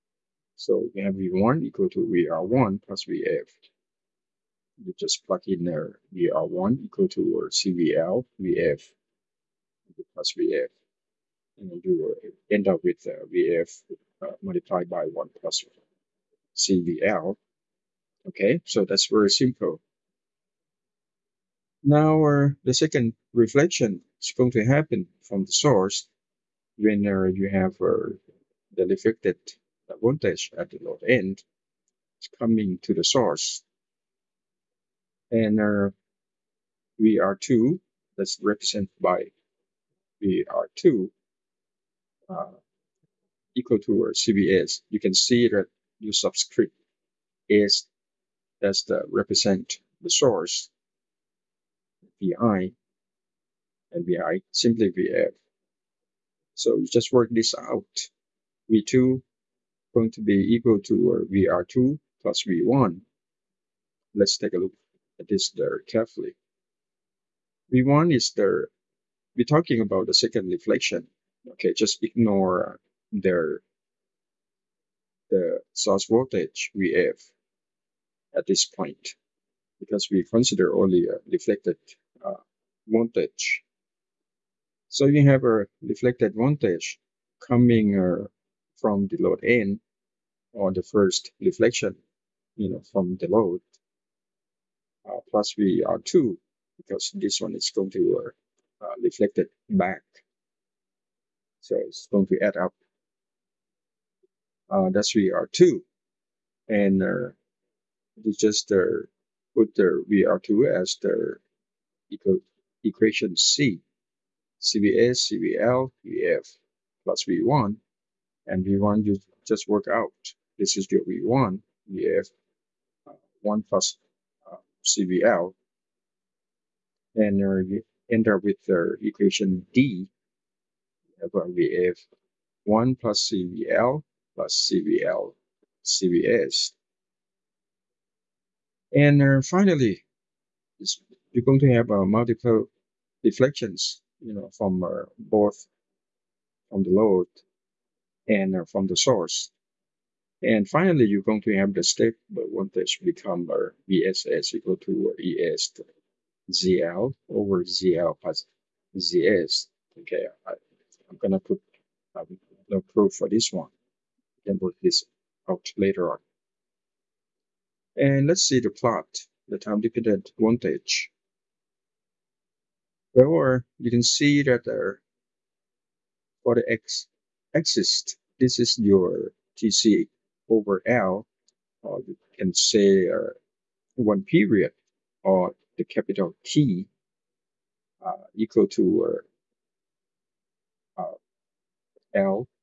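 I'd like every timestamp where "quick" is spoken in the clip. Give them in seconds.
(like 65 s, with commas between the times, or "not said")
not said.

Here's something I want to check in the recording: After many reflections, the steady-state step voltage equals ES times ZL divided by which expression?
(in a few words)
ZL plus ZS.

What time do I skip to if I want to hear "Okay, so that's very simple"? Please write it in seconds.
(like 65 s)
18 s.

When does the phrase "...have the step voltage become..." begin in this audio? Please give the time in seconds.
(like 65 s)
151 s.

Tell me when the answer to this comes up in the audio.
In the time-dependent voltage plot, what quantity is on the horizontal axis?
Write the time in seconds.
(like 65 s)
179 s.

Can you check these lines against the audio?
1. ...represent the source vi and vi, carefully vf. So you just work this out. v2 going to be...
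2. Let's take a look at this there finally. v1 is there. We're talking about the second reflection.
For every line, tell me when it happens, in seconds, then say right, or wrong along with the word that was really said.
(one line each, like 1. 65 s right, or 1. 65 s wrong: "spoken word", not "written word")
1. 49 s wrong: "simply", not "carefully"
2. 64 s wrong: "carefully", not "finally".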